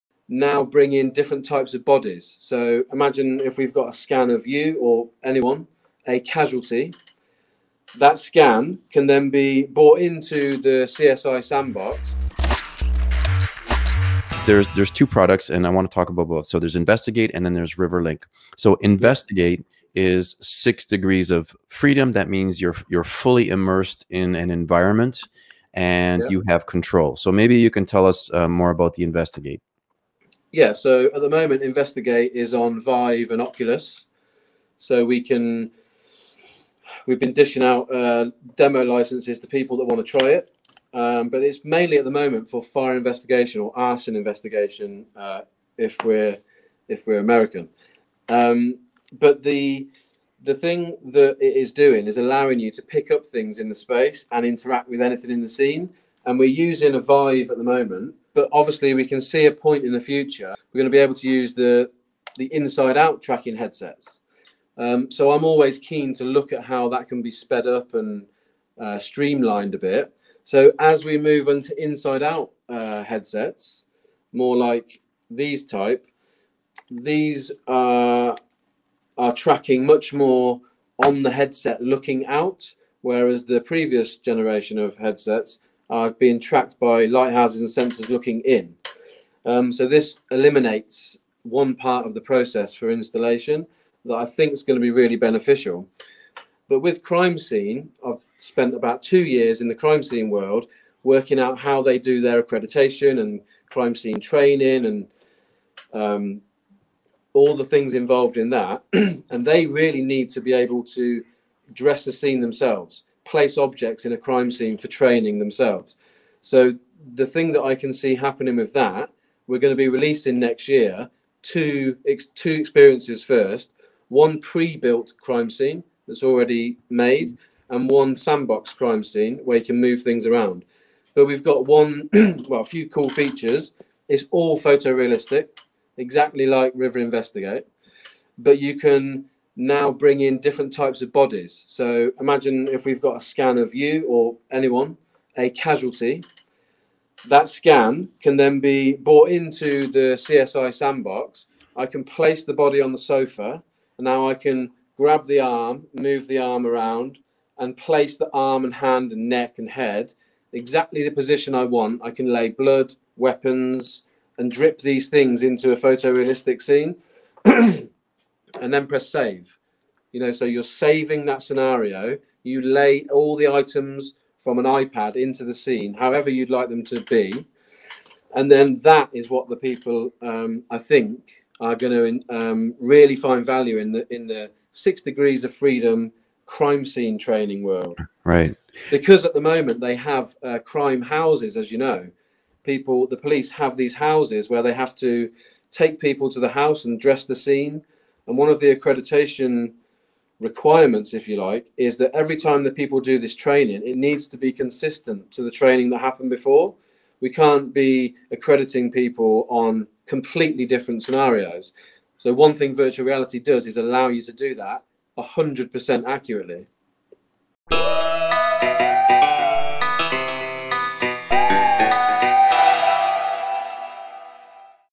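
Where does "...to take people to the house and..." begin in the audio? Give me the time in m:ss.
3:14.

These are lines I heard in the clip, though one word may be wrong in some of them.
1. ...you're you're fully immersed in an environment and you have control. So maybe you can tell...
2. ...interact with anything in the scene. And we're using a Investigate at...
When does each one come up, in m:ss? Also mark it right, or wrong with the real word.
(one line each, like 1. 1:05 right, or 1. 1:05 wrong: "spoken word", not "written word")
1. 0:22 right
2. 0:54 wrong: "Vive", not "Investigate".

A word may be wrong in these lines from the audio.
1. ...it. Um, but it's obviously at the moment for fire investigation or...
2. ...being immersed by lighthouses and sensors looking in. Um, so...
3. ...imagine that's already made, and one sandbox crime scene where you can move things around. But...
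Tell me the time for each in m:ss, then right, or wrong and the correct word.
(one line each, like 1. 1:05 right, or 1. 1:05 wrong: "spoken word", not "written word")
1. 0:40 wrong: "mainly", not "obviously"
2. 1:26 wrong: "tracked", not "immersed"
3. 2:05 wrong: "scene", not "imagine".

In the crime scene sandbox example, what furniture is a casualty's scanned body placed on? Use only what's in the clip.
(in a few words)
sofa.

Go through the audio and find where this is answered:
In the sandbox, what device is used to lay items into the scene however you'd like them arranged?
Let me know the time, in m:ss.
2:54.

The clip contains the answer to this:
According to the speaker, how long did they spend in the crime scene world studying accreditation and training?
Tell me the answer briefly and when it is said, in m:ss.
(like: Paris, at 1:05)
2 years, at 1:39.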